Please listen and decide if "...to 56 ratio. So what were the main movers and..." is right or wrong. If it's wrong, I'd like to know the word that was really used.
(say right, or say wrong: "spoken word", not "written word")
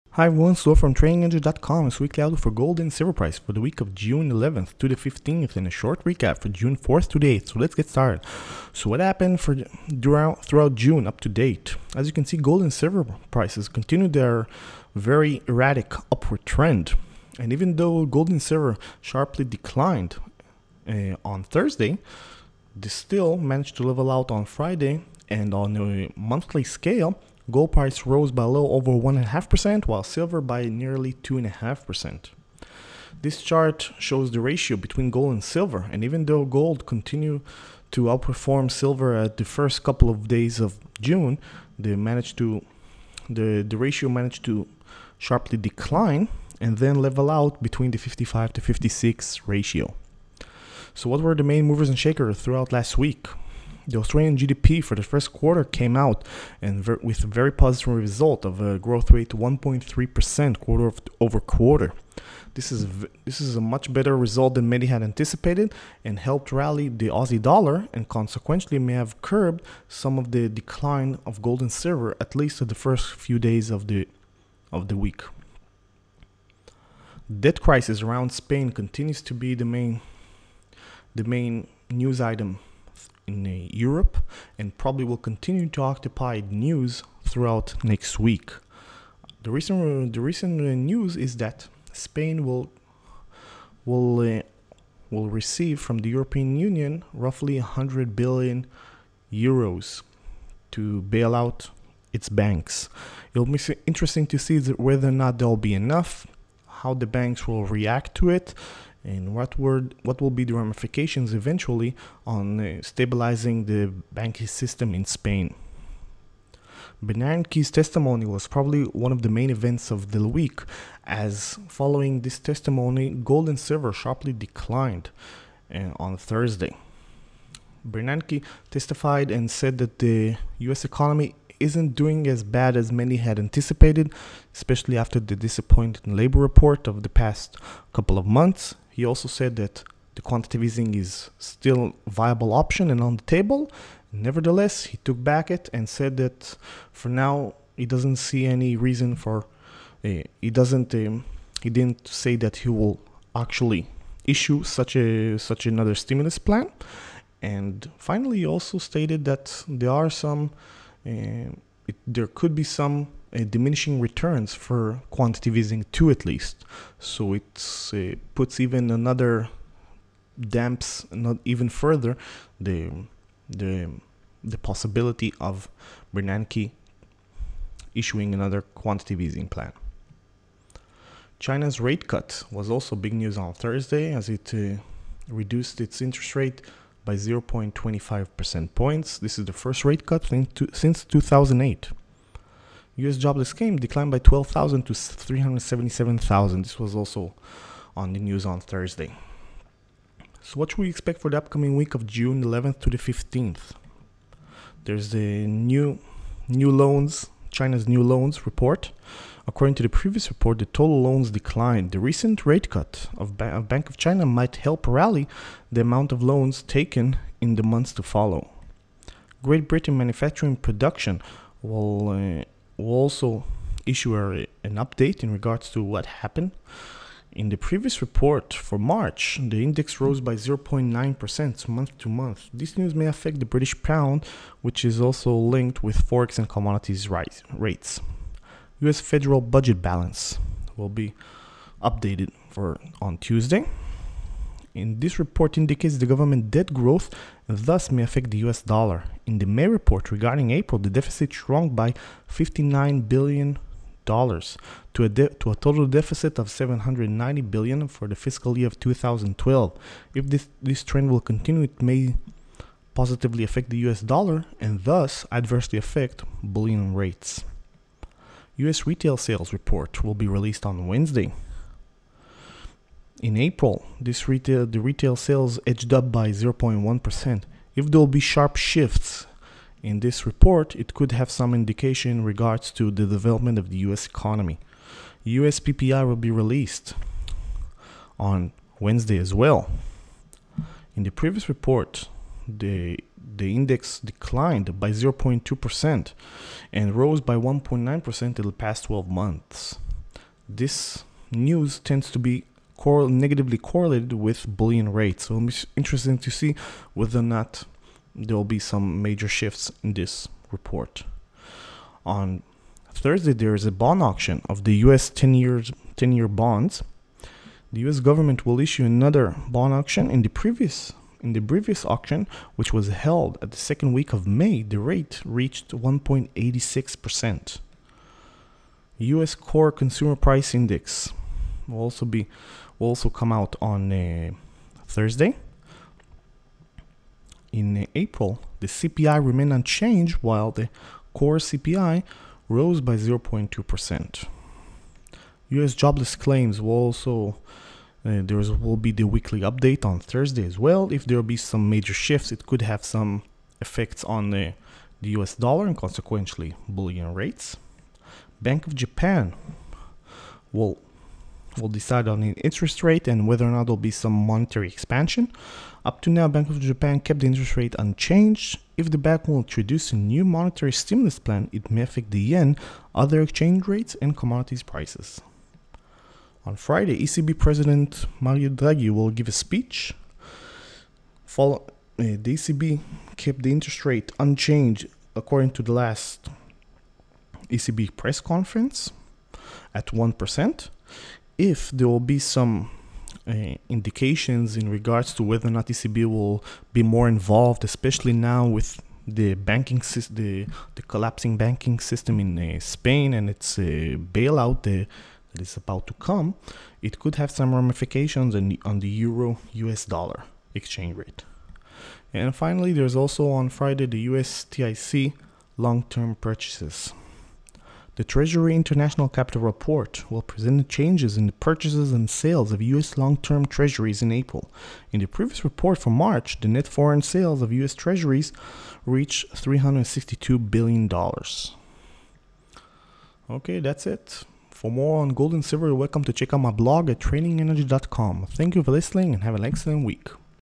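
right.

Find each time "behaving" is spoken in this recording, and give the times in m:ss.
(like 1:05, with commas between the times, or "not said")
not said.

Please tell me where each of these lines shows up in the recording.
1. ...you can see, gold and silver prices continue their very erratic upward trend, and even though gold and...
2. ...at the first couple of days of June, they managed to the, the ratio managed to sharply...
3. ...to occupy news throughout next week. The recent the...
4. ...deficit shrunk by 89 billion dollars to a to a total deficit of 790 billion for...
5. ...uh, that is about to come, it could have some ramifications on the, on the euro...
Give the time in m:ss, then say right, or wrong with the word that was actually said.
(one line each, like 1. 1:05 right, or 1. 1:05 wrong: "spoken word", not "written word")
1. 0:12 right
2. 0:39 right
3. 1:25 right
4. 4:10 wrong: "59", not "89"
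5. 6:44 right.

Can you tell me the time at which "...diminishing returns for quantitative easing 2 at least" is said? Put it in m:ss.
2:43.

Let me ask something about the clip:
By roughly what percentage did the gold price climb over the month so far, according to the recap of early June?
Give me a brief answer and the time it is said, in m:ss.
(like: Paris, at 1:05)
a little over 1.5%, at 0:28.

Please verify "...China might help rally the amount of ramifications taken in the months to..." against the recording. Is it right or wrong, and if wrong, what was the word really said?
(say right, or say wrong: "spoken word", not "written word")
wrong: "loans", not "ramifications".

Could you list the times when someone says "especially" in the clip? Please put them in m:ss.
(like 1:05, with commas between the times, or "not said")
2:14, 6:37.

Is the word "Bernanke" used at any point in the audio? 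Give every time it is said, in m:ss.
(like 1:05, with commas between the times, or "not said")
1:57, 2:07, 2:56.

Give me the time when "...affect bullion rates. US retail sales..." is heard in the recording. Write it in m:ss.
4:25.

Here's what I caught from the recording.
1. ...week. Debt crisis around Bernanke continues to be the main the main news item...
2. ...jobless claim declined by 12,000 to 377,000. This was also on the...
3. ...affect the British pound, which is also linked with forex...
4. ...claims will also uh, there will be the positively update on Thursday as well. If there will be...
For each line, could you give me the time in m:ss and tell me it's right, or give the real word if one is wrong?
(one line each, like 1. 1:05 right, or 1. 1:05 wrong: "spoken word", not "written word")
1. 1:15 wrong: "Spain", not "Bernanke"
2. 3:13 right
3. 3:53 right
4. 5:46 wrong: "weekly", not "positively".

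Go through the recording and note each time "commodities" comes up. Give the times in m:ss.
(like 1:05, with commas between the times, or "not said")
3:56, 6:14.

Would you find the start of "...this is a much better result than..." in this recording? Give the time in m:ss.
1:03.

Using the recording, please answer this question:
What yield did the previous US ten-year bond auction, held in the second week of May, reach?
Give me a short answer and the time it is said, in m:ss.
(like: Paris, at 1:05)
1.86%, at 5:25.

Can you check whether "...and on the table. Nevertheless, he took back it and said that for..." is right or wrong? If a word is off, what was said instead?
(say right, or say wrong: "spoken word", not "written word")
right.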